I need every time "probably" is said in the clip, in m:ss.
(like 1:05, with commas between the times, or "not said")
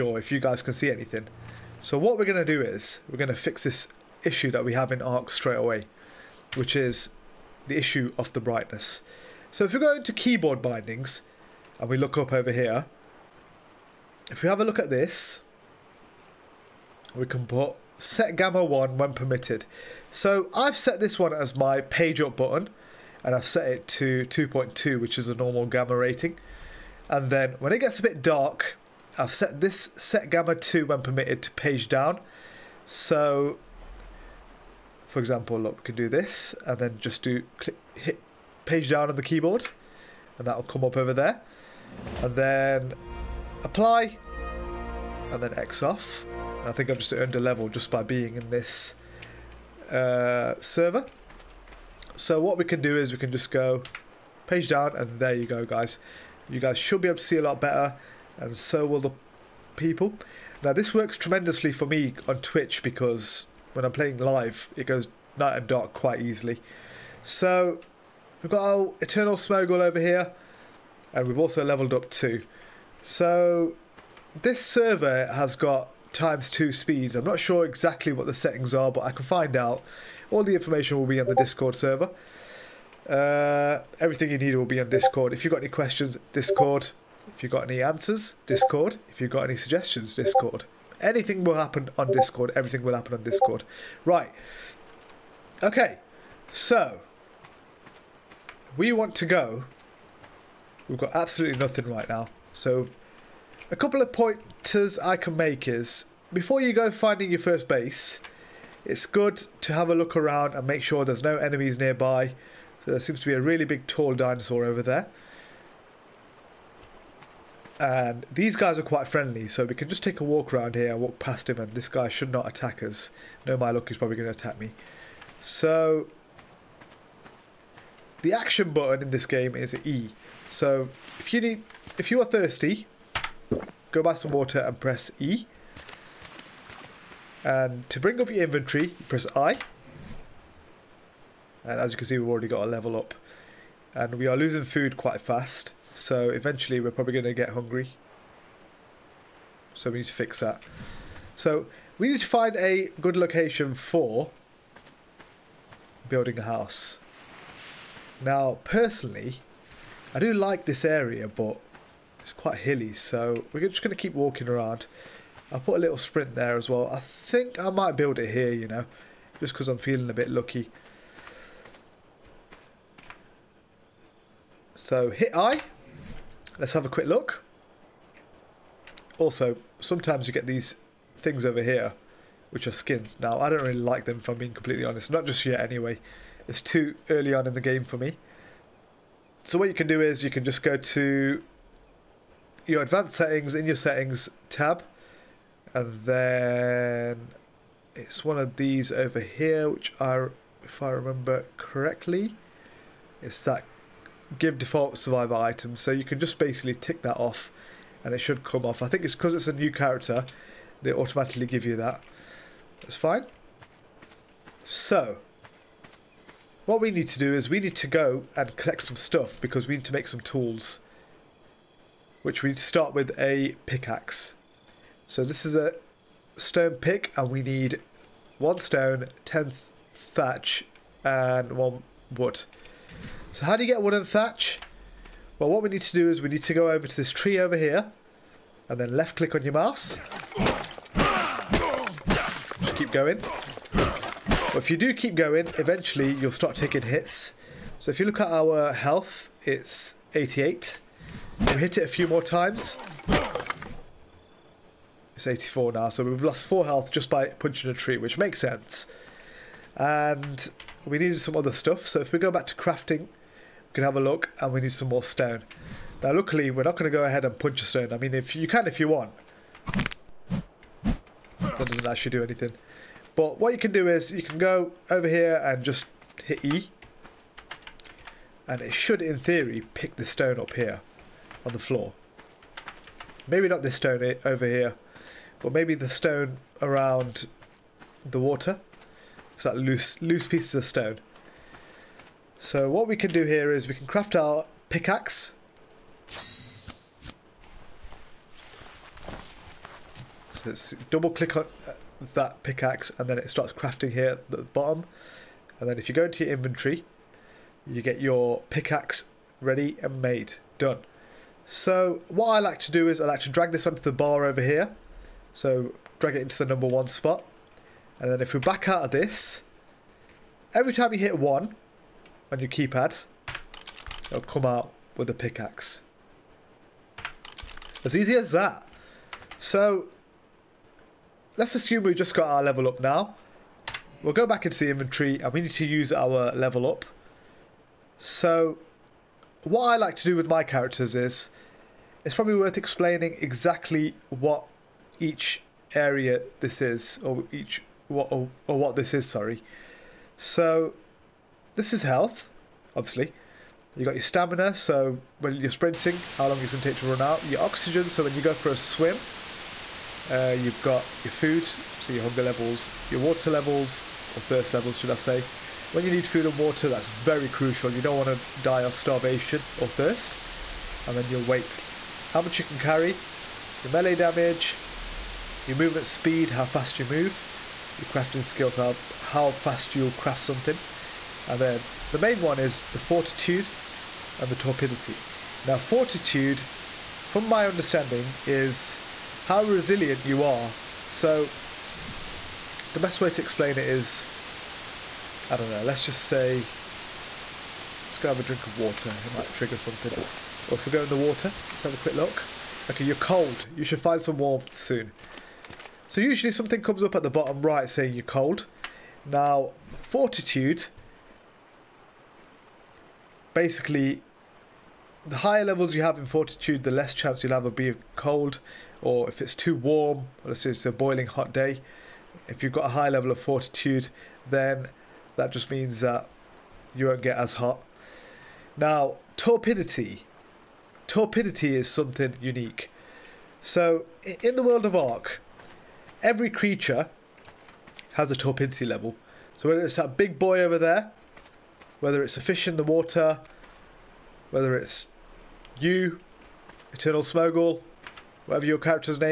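2:03, 2:26, 5:42.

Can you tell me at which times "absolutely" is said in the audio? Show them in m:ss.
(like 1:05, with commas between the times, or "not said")
1:41.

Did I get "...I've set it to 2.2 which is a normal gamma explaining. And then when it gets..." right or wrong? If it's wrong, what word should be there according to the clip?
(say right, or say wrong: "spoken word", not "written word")
wrong: "rating", not "explaining".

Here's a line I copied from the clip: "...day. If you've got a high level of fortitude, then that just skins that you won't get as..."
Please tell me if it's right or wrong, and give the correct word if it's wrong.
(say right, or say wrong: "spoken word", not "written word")
wrong: "means", not "skins".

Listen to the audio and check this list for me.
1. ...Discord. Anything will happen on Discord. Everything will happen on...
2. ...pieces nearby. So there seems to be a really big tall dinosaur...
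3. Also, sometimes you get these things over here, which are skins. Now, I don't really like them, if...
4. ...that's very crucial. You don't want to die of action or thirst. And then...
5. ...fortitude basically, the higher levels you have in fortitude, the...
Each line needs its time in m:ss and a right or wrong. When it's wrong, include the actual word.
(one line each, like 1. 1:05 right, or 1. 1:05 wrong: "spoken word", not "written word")
1. 1:30 right
2. 1:51 wrong: "enemies", not "pieces"
3. 2:59 right
4. 6:06 wrong: "starvation", not "action"
5. 6:49 right.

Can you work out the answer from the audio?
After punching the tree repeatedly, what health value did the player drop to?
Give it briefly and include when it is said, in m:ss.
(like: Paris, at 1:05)
84, at 4:15.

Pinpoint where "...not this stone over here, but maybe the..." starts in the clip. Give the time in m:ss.
4:43.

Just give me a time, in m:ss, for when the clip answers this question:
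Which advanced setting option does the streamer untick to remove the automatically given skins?
3:24.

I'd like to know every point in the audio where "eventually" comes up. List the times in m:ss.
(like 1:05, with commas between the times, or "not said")
2:26, 4:05.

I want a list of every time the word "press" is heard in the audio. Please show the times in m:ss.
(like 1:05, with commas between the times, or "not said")
2:14, 2:19.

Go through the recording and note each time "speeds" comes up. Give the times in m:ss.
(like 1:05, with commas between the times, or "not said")
1:16, 6:15.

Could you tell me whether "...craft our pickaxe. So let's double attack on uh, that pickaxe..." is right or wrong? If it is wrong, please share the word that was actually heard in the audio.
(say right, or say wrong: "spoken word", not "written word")
wrong: "click", not "attack".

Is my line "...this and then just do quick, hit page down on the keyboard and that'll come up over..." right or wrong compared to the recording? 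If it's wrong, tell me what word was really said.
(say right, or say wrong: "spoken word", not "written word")
wrong: "click", not "quick".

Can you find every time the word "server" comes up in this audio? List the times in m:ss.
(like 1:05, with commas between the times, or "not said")
0:50, 1:14, 1:21.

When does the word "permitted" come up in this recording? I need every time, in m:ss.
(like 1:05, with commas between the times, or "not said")
0:19, 0:31.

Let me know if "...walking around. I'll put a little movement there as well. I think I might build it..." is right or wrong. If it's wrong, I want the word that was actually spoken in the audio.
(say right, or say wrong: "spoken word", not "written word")
wrong: "sprint", not "movement".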